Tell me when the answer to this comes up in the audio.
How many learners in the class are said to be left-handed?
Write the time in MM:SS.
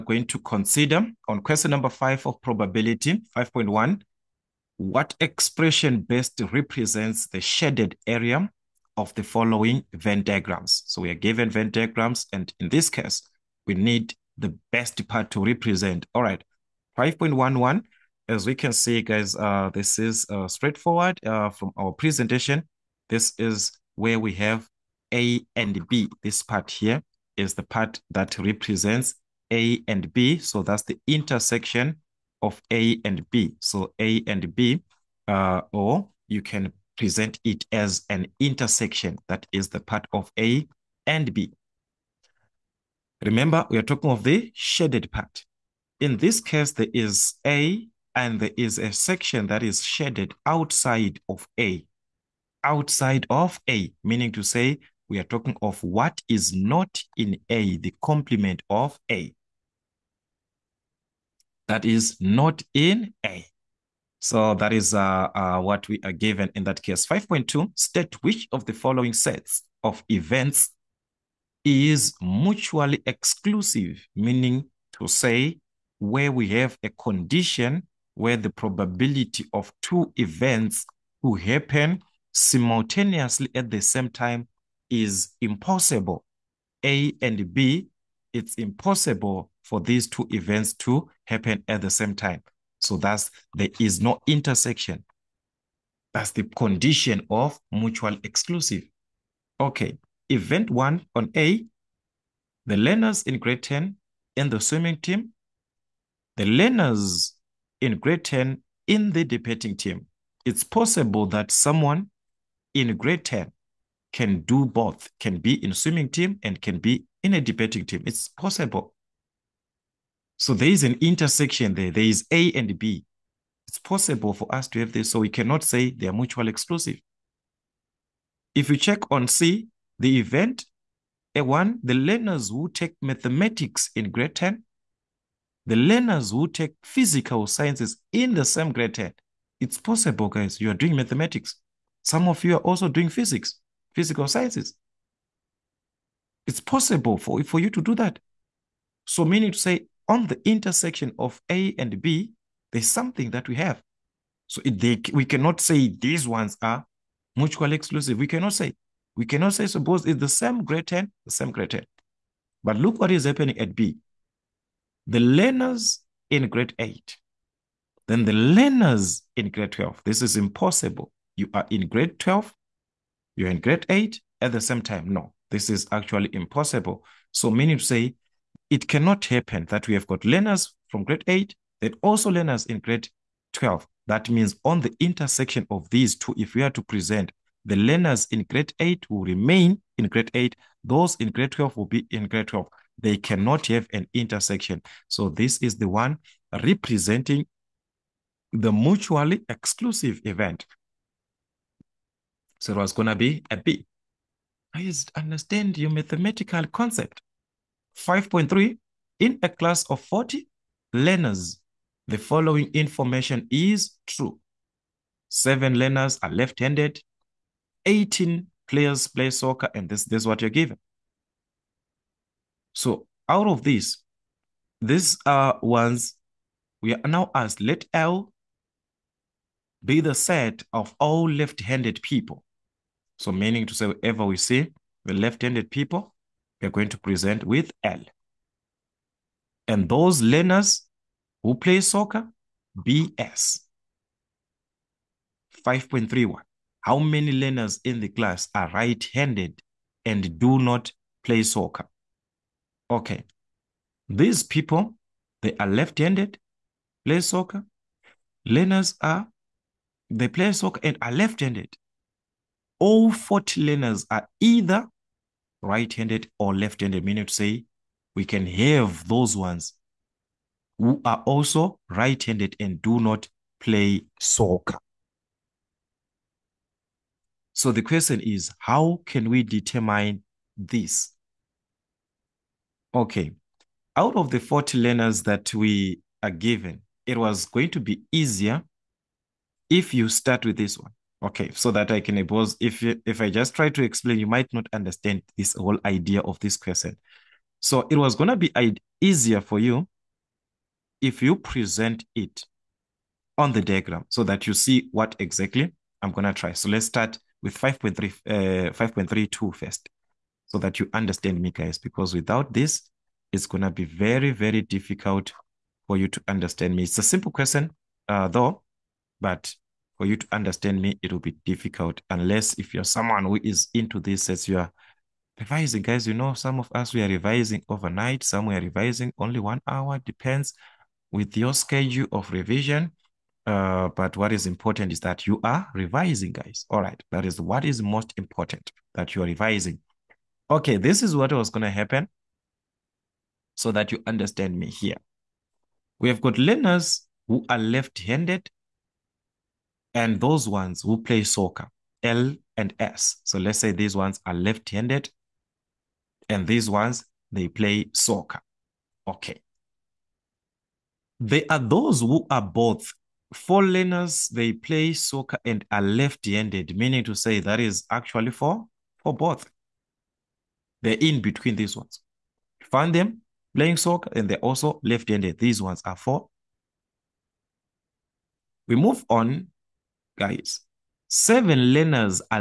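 03:35.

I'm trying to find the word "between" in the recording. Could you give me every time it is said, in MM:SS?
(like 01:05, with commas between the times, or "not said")
06:11.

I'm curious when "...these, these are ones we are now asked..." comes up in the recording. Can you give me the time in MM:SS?
03:43.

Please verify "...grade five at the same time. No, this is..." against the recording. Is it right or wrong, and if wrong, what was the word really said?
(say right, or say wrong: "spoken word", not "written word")
wrong: "eight", not "five".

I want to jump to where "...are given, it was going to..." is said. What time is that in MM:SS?
04:46.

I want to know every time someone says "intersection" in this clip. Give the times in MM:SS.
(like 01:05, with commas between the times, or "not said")
00:31, 00:38, 01:34, 02:00, 02:30, 03:04, 03:14.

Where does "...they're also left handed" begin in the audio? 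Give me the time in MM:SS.
06:14.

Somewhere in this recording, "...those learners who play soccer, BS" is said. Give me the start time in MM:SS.
03:59.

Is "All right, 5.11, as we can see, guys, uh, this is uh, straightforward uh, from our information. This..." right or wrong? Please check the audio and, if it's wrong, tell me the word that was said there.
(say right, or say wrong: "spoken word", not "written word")
wrong: "presentation", not "information".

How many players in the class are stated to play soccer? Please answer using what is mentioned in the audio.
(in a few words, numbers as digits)
18.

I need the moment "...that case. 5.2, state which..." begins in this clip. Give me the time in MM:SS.
01:06.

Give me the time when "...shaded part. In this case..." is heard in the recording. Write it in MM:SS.
00:44.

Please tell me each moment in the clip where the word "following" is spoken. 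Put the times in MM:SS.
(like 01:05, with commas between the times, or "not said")
00:09, 01:08, 03:32.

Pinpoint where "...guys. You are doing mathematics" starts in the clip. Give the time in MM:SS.
02:20.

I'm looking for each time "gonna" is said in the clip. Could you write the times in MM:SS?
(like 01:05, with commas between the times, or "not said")
04:58, 05:06, 05:13.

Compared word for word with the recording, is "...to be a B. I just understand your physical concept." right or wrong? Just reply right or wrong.
wrong.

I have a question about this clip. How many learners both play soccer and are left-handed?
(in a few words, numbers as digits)
4.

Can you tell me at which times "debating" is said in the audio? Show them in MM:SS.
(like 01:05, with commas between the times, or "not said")
01:49, 01:57.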